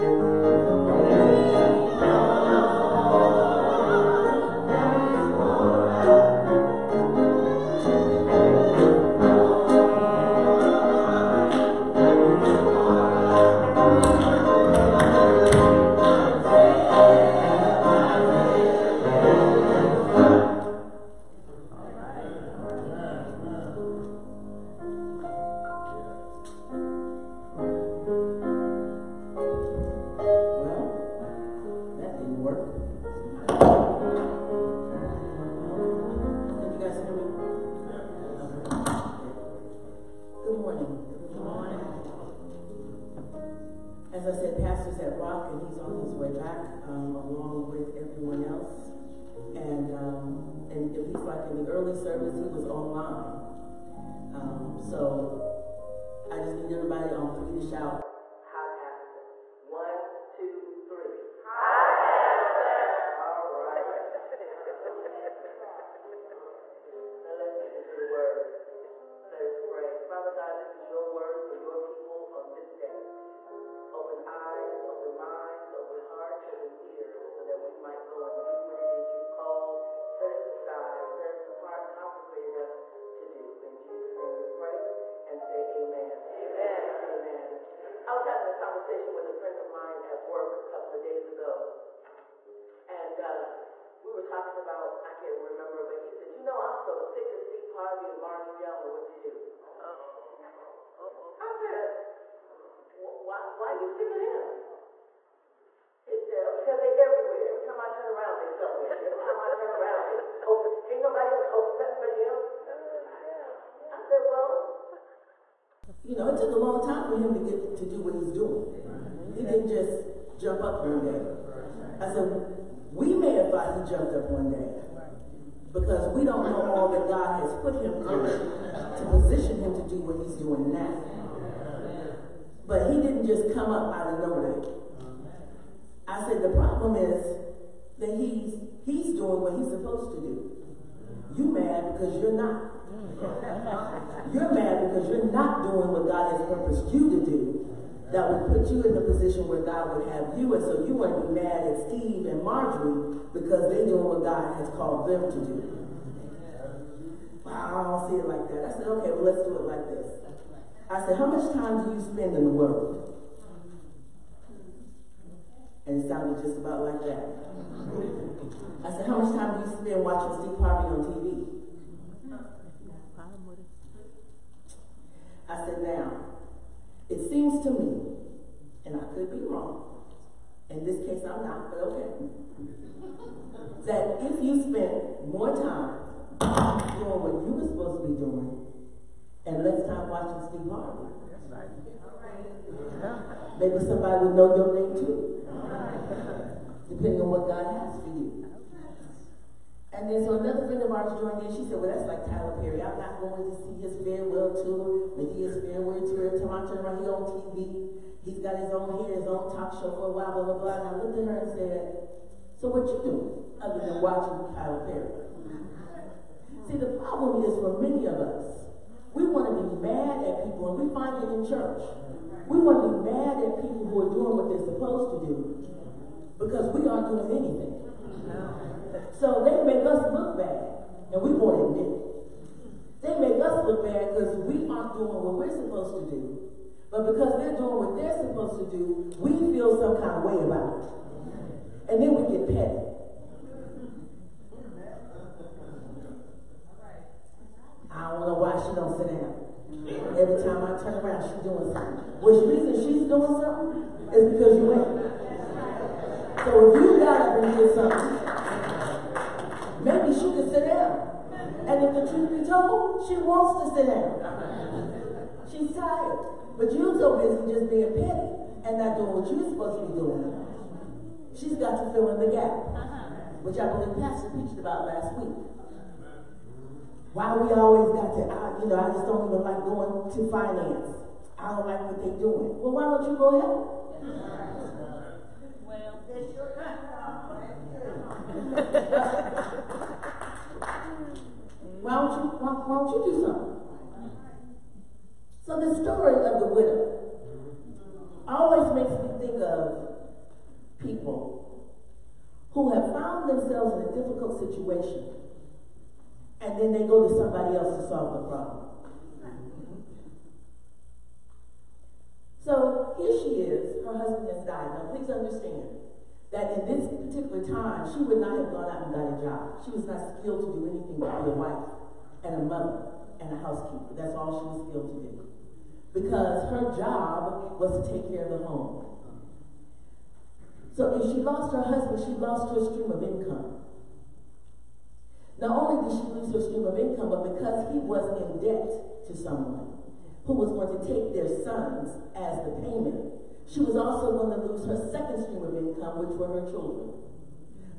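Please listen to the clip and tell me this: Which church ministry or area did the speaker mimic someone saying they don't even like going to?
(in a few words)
Finance.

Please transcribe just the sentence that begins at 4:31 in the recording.
She's got to fill in the gap, which I believe Pastor preached about last week.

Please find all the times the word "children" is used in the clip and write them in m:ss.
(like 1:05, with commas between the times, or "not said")
5:46.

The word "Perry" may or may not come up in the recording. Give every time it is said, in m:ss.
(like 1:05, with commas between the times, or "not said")
3:22, 3:34.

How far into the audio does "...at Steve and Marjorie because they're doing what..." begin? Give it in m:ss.
2:31.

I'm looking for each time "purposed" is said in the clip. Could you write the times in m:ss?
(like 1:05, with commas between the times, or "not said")
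2:26.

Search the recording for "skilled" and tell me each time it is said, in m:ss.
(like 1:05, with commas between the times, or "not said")
5:20, 5:24.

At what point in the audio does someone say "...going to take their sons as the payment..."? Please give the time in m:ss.
5:40.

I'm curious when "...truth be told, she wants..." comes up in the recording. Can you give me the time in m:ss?
4:22.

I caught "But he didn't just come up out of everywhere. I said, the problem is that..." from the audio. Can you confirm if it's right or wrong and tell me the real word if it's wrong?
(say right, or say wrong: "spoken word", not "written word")
wrong: "nowhere", not "everywhere".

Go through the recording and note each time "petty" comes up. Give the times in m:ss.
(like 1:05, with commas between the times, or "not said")
4:02, 4:27.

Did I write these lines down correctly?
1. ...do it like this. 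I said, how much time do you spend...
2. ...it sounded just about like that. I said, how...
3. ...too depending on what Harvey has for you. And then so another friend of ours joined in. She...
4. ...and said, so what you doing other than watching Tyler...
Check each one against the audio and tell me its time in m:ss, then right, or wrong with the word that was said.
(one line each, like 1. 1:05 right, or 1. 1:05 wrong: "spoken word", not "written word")
1. 2:39 right
2. 2:46 right
3. 3:14 wrong: "God", not "Harvey"
4. 3:31 right.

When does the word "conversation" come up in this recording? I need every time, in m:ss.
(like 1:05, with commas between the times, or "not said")
1:28.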